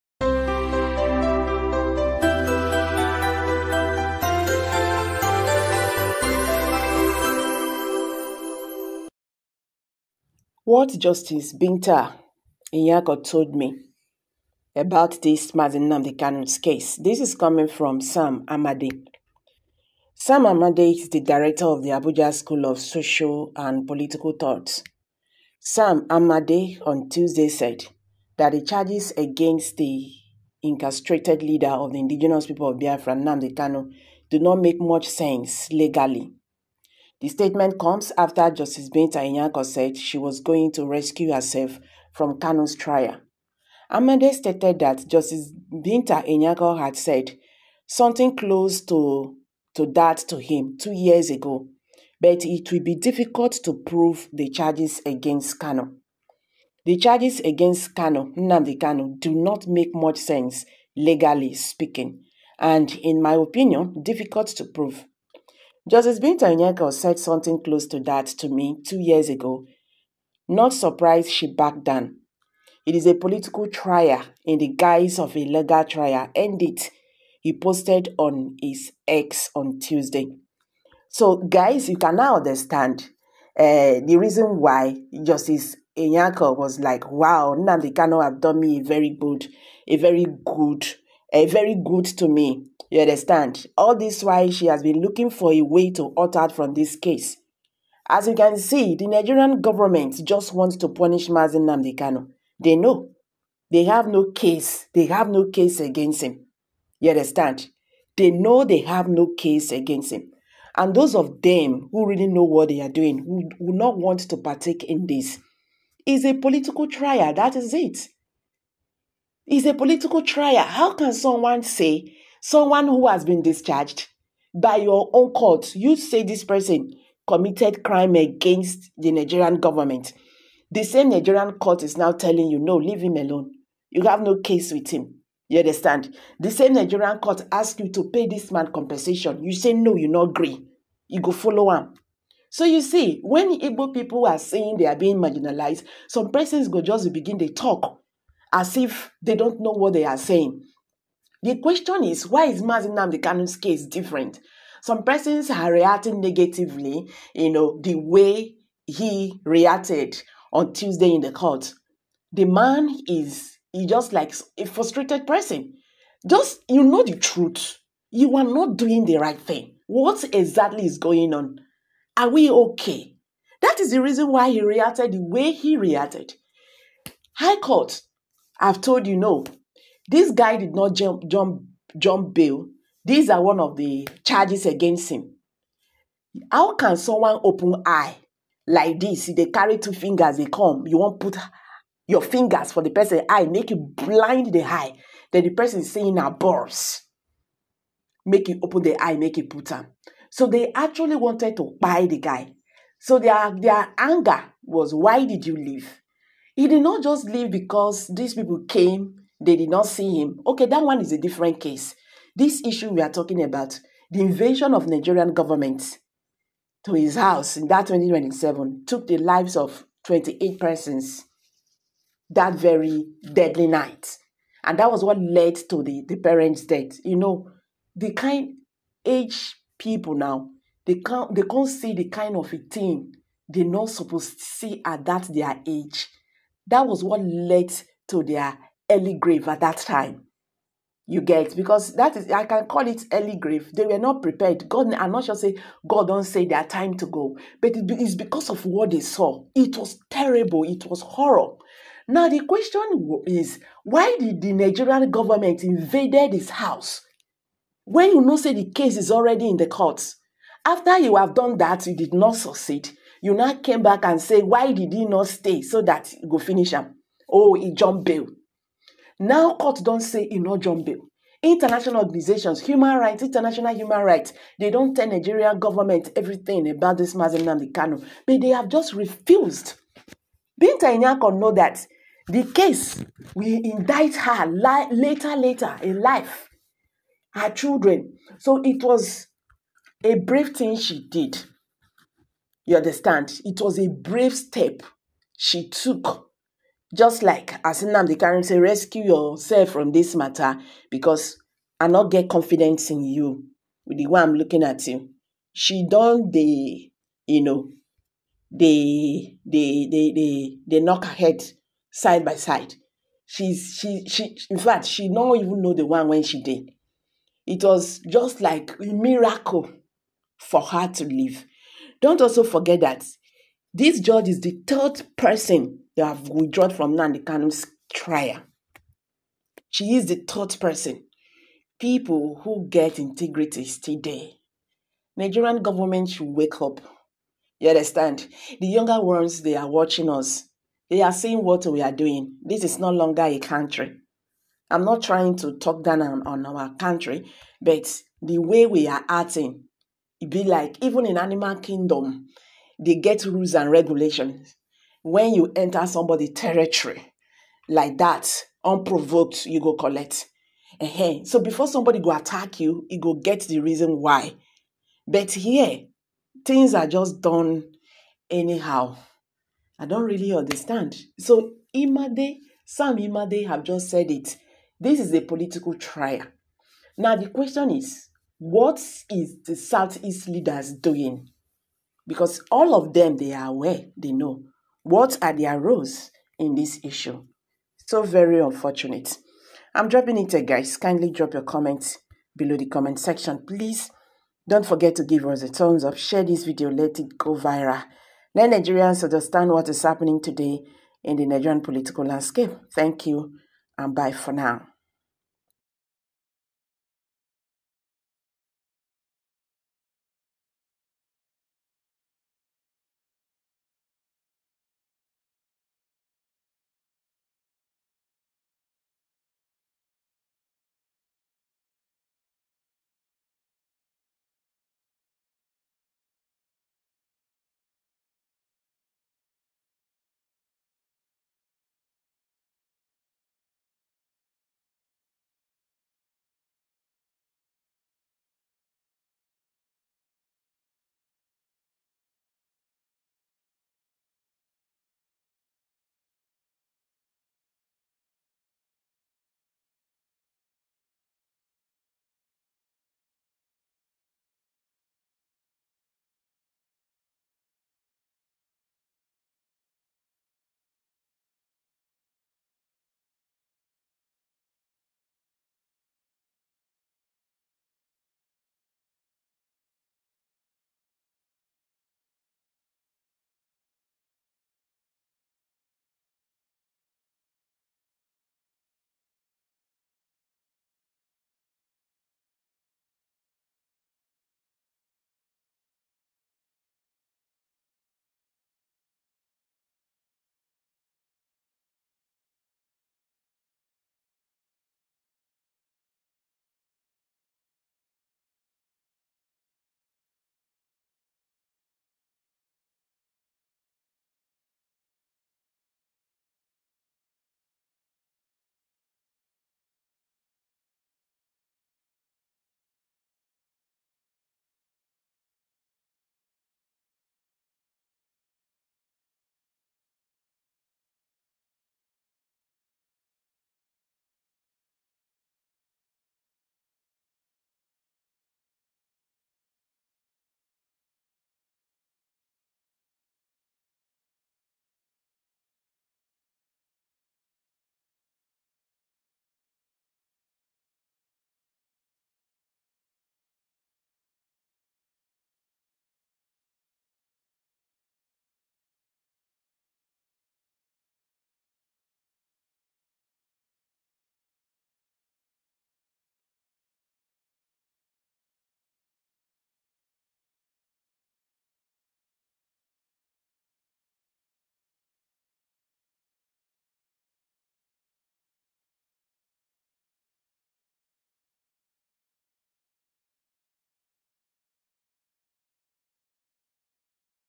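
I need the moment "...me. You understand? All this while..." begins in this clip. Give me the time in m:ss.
1:32.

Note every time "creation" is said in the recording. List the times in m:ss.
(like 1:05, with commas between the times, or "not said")
not said.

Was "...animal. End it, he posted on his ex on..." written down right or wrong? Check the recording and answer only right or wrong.
wrong.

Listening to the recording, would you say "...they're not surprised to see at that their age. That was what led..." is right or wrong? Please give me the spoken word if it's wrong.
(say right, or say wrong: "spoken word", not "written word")
wrong: "supposed", not "surprised".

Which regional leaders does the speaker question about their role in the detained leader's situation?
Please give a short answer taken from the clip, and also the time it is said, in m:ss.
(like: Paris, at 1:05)
Southeast leaders, at 6:19.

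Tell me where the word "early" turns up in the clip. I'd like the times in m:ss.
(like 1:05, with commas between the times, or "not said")
3:58, 4:03.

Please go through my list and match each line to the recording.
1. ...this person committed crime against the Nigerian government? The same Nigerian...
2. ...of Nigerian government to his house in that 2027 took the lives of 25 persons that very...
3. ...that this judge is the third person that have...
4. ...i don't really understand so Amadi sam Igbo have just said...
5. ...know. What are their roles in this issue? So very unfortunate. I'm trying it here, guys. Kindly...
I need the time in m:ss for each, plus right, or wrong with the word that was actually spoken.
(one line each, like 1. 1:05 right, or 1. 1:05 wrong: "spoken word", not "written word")
1. 2:06 right
2. 3:34 wrong: "28", not "25"
3. 5:22 right
4. 6:09 wrong: "Amadi", not "Igbo"
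5. 6:24 wrong: "dropping", not "trying".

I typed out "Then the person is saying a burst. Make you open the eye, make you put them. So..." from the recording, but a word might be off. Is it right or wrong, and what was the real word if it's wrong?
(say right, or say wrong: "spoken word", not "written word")
right.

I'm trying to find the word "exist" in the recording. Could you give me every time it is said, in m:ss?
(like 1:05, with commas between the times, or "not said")
not said.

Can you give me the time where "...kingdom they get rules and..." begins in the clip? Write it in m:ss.
5:51.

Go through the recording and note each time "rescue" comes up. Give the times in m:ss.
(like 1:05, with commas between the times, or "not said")
0:40, 4:58.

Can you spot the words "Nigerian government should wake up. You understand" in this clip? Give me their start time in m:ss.
5:35.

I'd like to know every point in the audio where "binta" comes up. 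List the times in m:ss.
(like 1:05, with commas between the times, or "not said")
0:11, 0:38, 0:45, 1:06, 4:40.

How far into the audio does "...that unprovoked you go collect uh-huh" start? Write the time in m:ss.
5:57.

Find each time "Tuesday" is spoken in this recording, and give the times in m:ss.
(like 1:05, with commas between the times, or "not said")
0:27, 1:19, 2:40.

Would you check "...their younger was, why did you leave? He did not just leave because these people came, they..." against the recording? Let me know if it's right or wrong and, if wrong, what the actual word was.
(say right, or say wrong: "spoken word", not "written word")
wrong: "anger", not "younger".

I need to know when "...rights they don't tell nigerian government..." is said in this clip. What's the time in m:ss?
4:34.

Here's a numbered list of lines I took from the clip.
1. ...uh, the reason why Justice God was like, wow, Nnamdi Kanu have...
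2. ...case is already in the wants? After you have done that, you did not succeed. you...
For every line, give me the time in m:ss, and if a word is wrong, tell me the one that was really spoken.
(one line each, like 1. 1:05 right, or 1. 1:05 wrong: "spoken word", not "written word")
1. 1:23 wrong: "Nyako", not "God"
2. 4:18 wrong: "courts", not "wants".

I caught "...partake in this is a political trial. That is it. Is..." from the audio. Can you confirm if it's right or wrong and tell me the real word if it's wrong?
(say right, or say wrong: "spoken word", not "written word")
right.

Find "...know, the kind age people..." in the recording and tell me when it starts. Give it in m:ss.
3:47.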